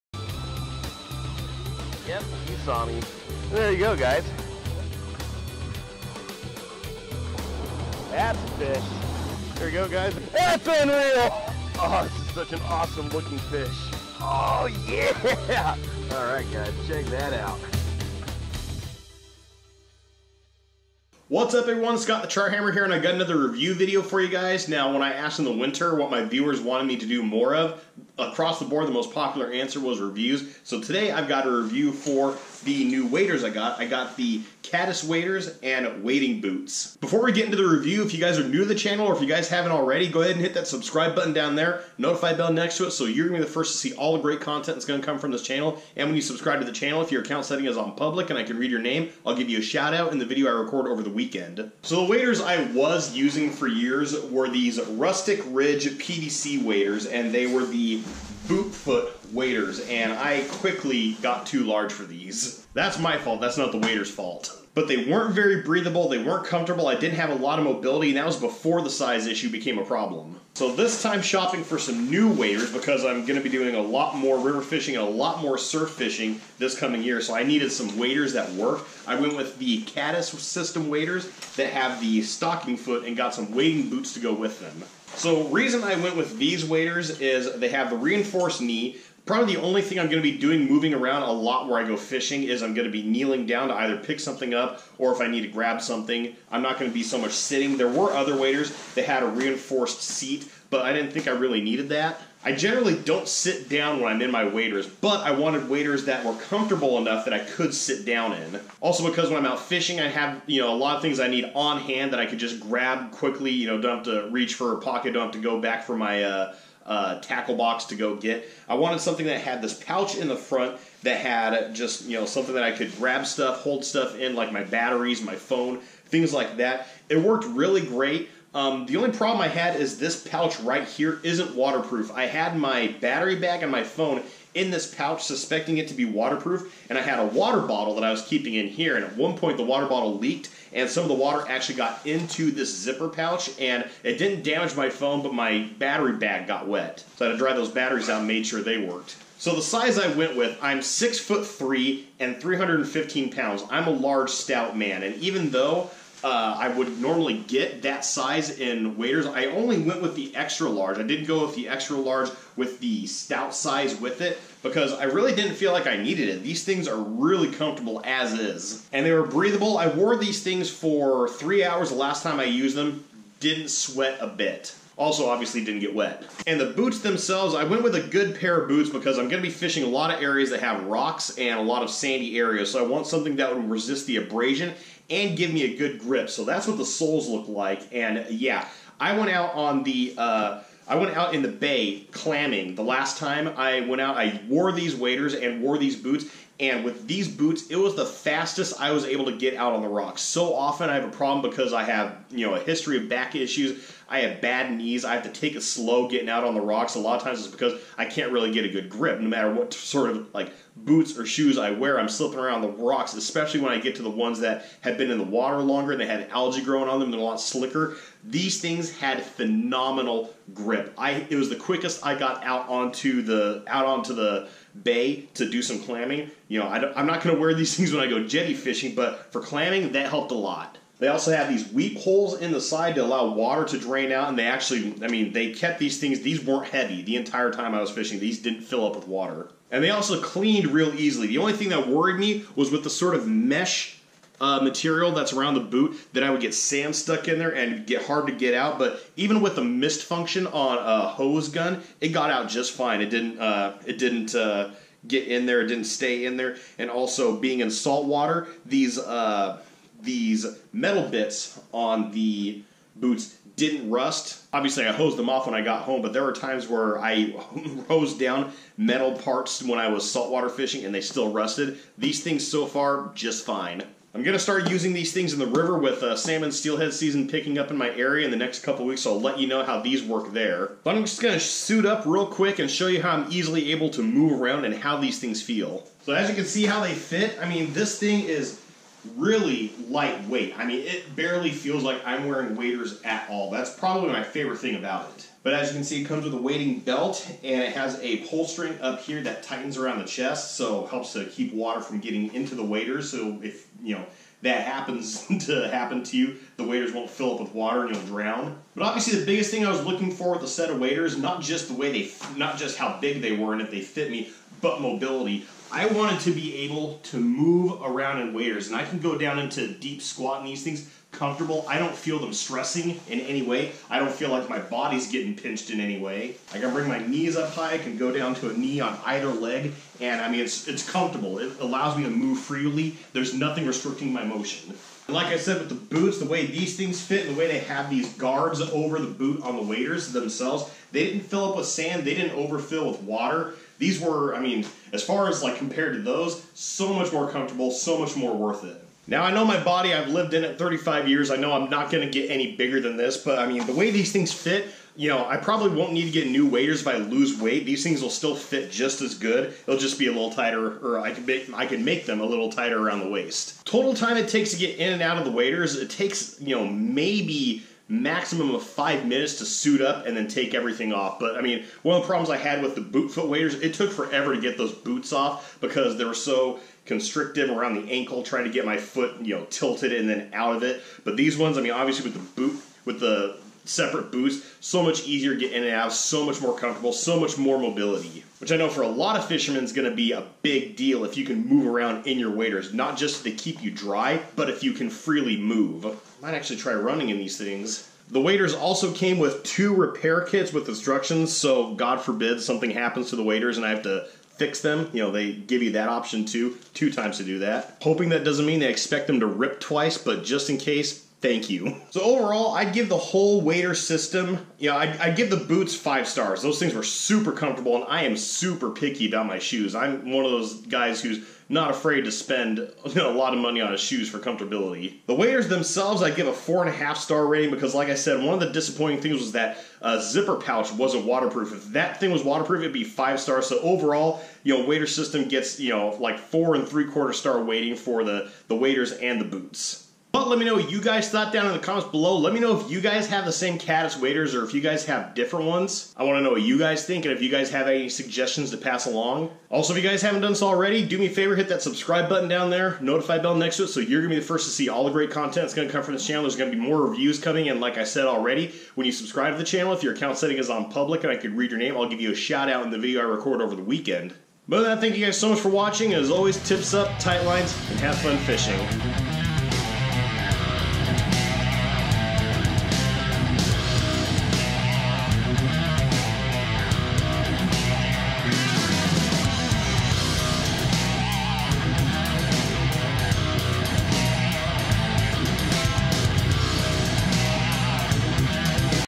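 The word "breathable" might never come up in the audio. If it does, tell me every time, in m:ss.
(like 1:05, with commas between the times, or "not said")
1:05, 2:49.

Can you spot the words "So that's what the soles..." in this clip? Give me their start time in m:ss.
3:06.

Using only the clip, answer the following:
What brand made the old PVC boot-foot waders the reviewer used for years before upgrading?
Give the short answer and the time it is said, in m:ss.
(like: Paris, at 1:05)
Rustic Ridge, at 0:54.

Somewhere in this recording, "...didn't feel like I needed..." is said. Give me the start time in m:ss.
2:45.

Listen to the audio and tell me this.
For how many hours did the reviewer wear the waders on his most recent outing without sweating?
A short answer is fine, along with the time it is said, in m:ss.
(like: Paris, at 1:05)
3 hours, at 2:51.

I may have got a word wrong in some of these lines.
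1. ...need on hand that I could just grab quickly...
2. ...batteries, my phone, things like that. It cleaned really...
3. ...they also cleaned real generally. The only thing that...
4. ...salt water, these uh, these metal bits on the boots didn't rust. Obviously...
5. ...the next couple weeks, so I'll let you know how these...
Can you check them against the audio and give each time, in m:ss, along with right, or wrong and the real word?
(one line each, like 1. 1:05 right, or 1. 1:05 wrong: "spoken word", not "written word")
1. 1:51 right
2. 2:04 wrong: "worked", not "cleaned"
3. 3:59 wrong: "easily", not "generally"
4. 4:17 right
5. 4:38 right.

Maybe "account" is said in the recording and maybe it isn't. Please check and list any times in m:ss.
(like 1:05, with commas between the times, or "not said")
0:47, 7:39.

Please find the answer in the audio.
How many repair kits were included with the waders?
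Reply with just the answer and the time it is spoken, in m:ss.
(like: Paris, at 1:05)
2, at 6:39.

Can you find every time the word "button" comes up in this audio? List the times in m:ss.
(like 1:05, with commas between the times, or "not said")
0:41, 7:32.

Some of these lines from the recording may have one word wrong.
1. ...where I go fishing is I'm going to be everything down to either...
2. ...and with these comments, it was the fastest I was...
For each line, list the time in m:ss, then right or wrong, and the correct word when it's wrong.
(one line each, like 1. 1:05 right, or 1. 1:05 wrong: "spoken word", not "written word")
1. 1:31 wrong: "kneeling", not "everything"
2. 3:16 wrong: "boots", not "comments".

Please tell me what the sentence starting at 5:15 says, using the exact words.
I wanted to be able to move around in waders, and I can go down into deep squat in these things comfortable.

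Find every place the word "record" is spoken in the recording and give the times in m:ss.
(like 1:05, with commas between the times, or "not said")
0:50, 7:43.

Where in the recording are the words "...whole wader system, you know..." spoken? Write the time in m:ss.
6:52.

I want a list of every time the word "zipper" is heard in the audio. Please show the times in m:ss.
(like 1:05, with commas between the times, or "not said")
2:22, 7:10.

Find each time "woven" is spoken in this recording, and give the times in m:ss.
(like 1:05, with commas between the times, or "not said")
not said.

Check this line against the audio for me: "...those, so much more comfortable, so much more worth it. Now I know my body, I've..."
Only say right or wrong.
right.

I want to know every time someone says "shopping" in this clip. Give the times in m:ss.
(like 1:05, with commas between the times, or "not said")
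1:11.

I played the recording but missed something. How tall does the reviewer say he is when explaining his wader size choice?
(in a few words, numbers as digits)
6 foot 3.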